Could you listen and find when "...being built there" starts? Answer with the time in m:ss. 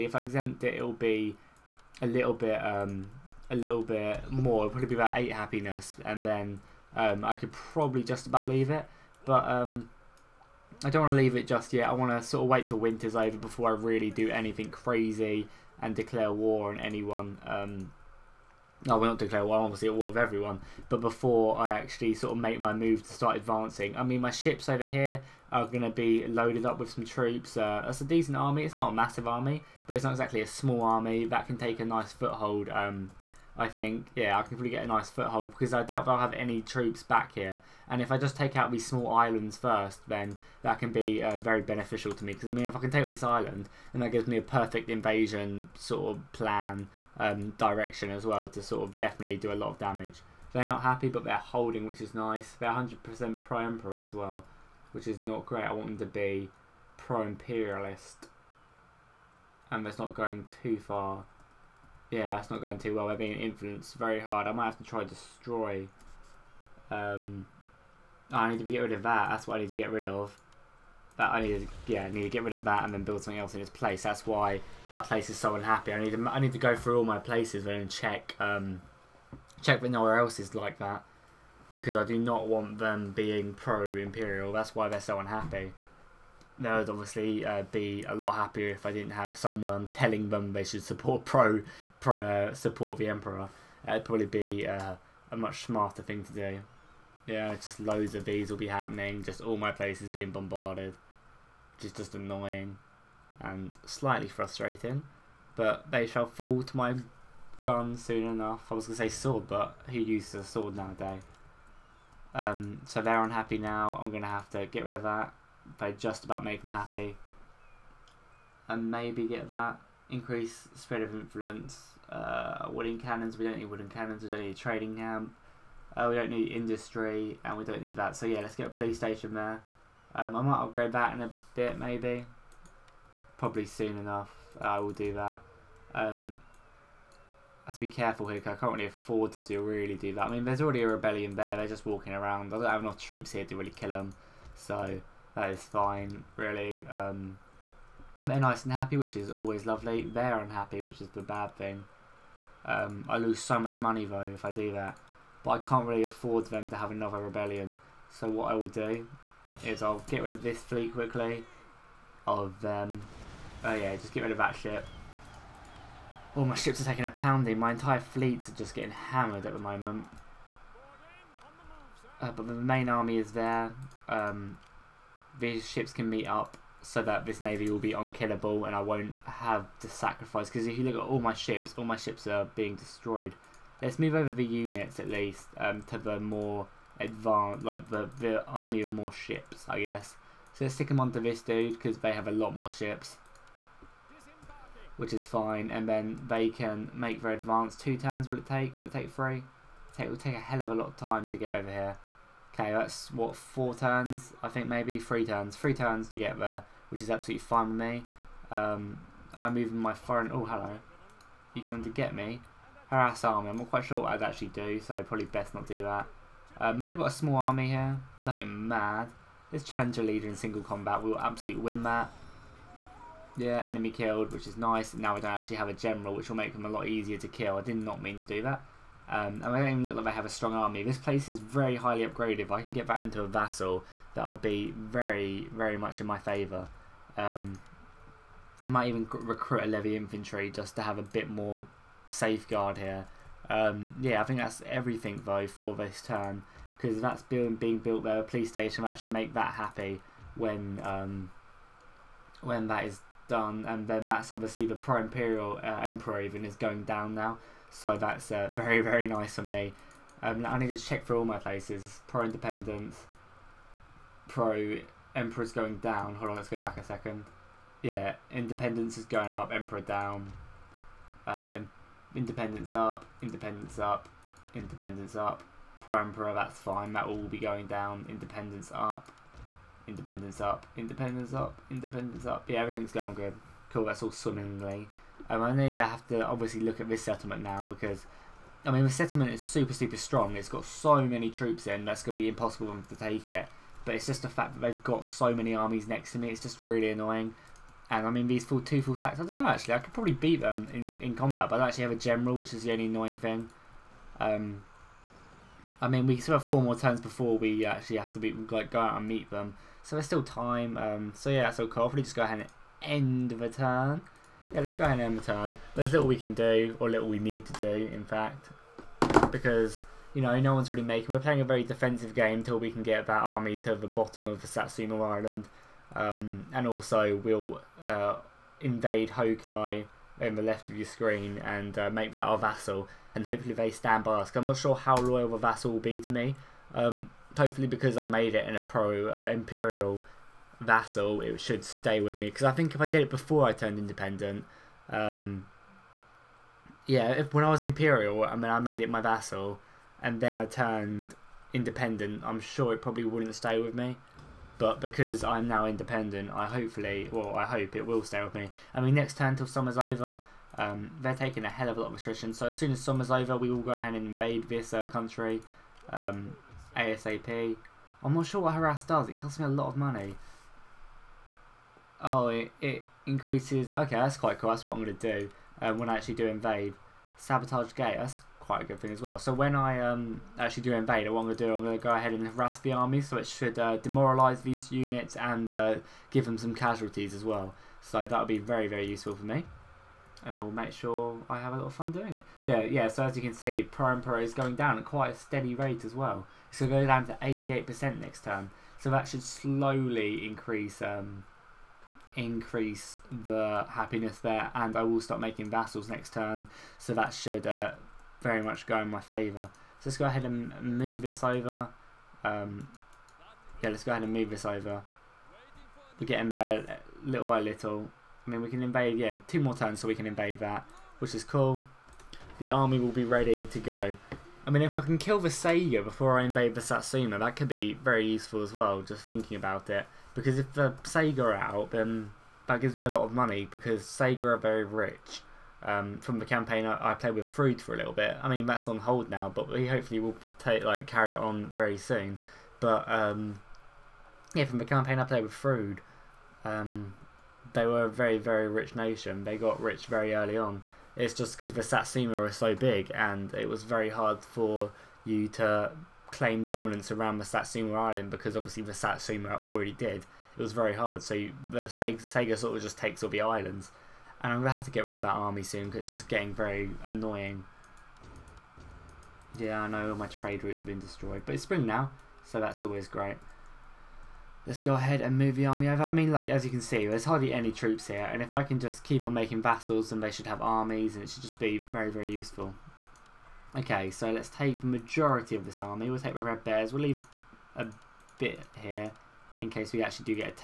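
4:07.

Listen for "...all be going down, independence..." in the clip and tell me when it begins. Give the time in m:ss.
4:37.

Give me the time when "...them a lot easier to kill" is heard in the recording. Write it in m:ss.
3:46.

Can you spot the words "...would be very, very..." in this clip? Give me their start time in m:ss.
6:28.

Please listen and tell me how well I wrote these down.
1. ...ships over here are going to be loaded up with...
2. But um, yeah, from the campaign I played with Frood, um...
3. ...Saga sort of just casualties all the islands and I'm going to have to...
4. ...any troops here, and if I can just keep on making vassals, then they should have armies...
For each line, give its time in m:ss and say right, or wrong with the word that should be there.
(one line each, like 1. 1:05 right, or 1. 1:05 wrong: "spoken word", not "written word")
1. 0:24 right
2. 7:22 right
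3. 7:42 wrong: "takes", not "casualties"
4. 7:57 right.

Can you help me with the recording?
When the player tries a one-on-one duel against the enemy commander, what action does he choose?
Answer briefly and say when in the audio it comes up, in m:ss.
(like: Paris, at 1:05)
Challenge a leader in single combat, at 3:40.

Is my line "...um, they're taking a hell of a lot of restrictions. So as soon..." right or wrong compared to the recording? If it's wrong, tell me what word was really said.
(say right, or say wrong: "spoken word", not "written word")
right.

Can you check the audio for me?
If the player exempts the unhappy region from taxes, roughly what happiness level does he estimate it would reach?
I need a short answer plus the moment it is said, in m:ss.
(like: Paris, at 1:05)
8, at 0:05.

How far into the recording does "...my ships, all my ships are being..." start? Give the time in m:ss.
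3:01.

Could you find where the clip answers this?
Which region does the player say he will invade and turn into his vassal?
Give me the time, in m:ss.
5:29.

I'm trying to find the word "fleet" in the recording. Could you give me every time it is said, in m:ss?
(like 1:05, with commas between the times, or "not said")
2:40, 2:48.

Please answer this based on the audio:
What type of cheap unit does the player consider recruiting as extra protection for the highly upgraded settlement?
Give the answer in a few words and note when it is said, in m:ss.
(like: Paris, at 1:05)
Levy infantry, at 3:59.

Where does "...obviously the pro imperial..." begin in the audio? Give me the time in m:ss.
4:14.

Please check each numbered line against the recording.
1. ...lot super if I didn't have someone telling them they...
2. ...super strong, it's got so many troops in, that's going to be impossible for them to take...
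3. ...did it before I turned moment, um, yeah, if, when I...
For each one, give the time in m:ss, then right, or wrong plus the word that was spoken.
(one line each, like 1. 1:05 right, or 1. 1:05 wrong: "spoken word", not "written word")
1. 1:28 wrong: "happier", not "super"
2. 4:49 right
3. 5:42 wrong: "independent", not "moment".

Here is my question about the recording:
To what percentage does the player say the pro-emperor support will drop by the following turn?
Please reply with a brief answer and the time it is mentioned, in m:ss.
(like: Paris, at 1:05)
88%, at 6:37.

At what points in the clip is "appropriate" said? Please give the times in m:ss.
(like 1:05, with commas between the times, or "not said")
not said.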